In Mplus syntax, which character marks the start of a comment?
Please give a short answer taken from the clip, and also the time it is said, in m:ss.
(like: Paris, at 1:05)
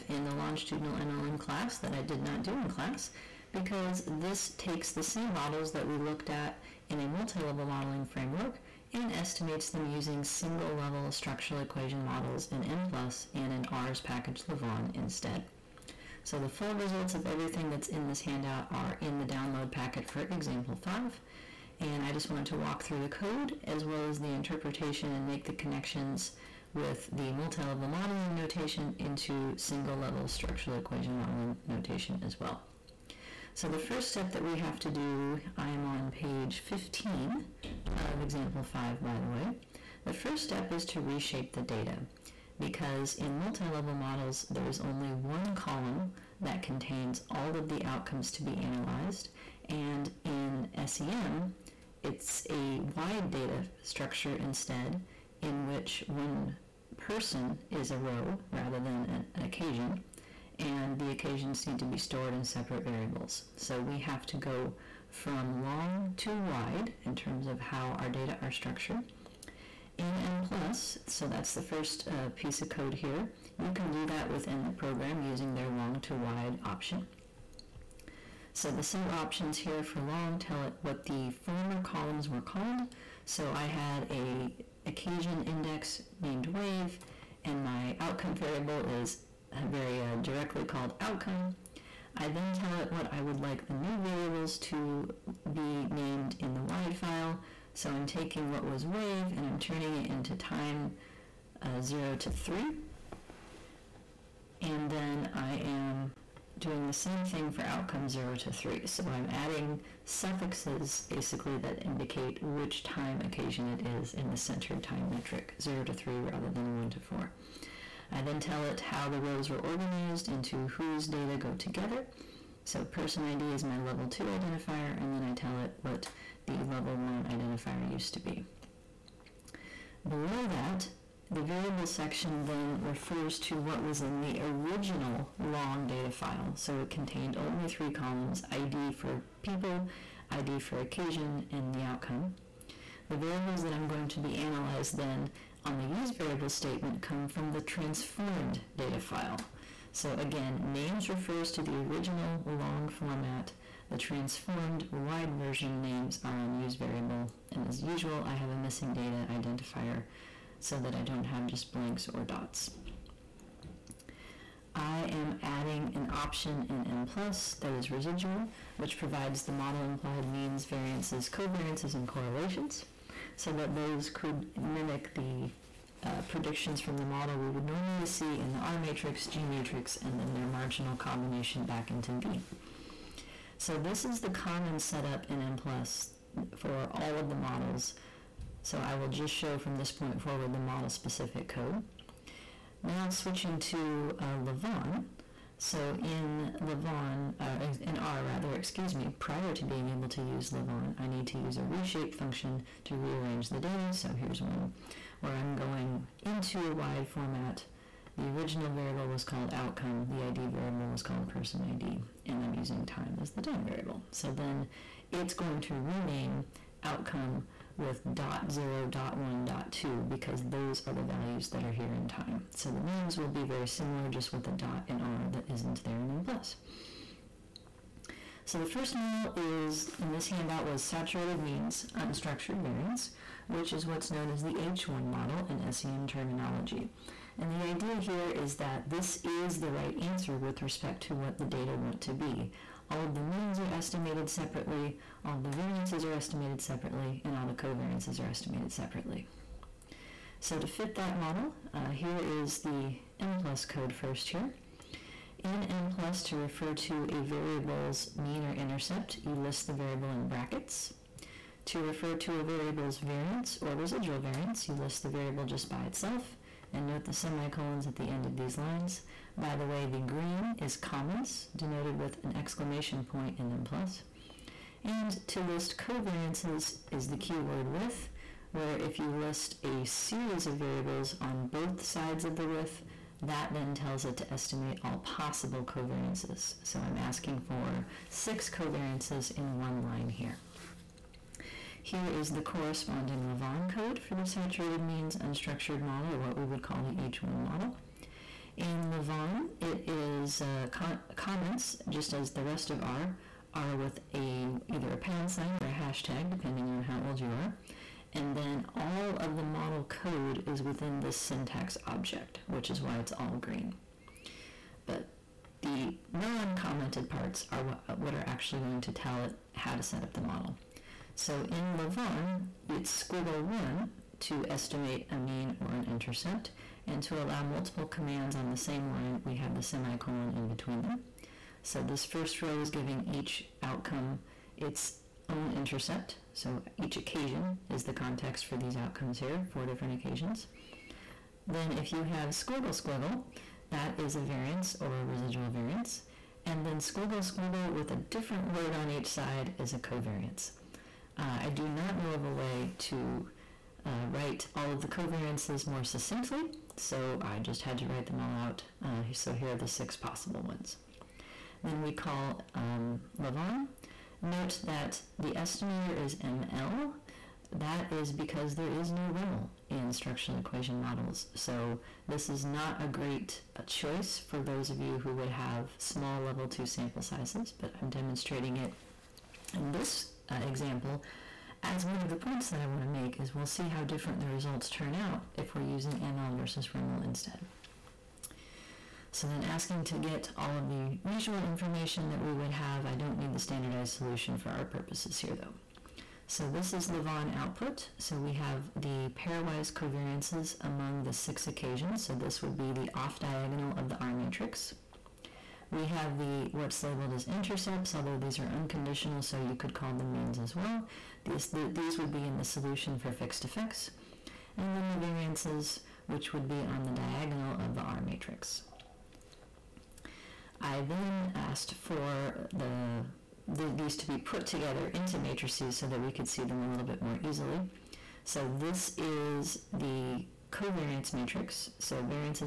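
exclamation point, at 4:32.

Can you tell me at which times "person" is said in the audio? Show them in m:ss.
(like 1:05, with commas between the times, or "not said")
0:56, 2:02, 3:31.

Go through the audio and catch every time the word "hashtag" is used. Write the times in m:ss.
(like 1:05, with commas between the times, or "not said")
5:05.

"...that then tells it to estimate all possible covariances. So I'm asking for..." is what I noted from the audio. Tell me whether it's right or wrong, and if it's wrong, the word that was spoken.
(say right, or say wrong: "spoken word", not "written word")
right.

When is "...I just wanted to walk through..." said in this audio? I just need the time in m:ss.
0:22.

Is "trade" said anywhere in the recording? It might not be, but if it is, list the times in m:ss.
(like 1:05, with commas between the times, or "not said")
not said.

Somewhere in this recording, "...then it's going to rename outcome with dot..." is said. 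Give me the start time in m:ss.
3:34.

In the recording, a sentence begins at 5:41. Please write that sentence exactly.
Then if you have squiggle squiggle, that is a variance or a residual variance.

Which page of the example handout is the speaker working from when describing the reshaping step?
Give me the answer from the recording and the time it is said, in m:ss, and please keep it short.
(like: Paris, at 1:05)
15, at 0:36.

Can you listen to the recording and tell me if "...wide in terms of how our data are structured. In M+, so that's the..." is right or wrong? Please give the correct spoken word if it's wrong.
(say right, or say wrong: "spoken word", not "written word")
right.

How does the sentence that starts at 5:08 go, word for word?
And then all of the model code is within this syntax object, which is why it's all green.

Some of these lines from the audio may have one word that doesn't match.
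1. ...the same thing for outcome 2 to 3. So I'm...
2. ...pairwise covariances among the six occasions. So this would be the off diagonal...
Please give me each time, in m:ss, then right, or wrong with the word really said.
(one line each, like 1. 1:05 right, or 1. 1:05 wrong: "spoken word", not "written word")
1. 1:46 wrong: "0", not "2"
2. 6:39 right.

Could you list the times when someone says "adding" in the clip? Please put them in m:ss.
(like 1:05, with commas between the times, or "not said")
1:49, 2:45.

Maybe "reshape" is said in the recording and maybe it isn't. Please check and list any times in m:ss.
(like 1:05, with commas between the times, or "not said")
0:41, 3:21.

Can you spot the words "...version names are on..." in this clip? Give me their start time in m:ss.
2:35.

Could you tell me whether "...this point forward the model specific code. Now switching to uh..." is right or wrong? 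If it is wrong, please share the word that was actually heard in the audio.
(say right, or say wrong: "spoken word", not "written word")
right.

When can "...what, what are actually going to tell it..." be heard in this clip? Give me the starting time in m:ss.
5:17.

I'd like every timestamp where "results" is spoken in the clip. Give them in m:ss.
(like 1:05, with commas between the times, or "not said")
0:16, 6:24.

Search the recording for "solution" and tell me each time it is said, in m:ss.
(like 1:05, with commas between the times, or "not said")
6:33, 6:52.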